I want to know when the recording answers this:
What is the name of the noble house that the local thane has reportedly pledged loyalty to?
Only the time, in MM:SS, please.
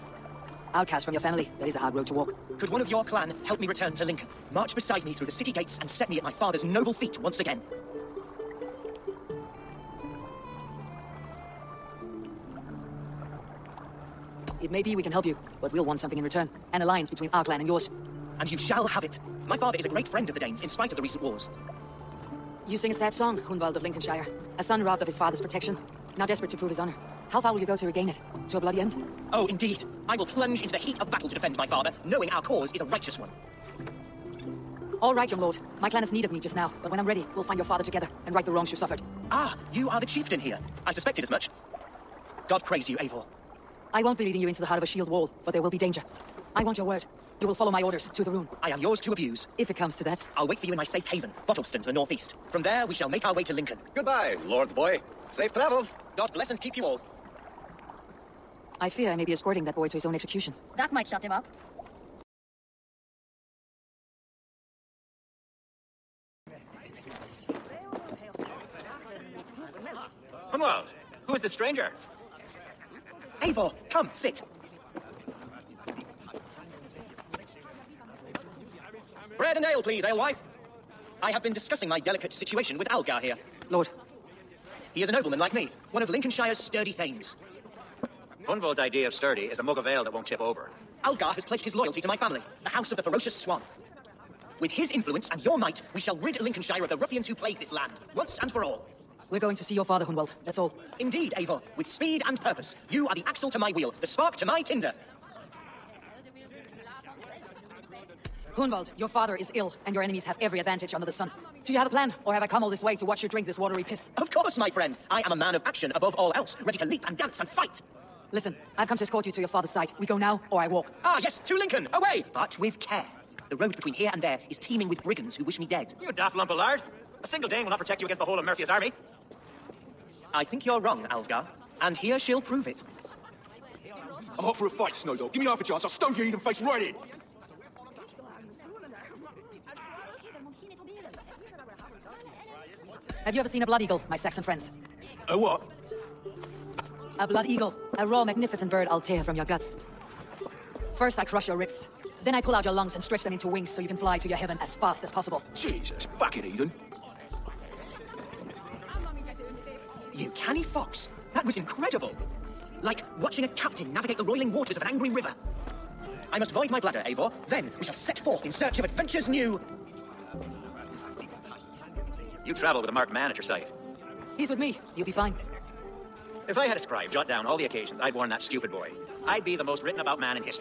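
01:32.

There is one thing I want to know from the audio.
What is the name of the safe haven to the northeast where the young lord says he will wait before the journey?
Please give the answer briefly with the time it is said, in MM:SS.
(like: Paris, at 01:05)
Bottleston, at 00:51.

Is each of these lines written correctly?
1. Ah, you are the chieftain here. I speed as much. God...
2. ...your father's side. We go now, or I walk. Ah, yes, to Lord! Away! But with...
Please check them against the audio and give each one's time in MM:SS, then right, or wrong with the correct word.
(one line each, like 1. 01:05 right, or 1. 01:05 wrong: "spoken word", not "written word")
1. 00:39 wrong: "suspected", not "speed"
2. 01:59 wrong: "Lincoln", not "Lord".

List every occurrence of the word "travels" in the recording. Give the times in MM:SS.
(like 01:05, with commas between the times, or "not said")
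00:55, 02:52.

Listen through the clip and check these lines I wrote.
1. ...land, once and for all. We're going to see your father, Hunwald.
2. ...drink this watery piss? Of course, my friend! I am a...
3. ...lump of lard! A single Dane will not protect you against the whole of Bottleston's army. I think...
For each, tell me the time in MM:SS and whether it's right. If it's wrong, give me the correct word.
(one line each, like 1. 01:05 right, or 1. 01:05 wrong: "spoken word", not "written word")
1. 01:37 right
2. 01:53 right
3. 02:06 wrong: "Mercia", not "Bottleston".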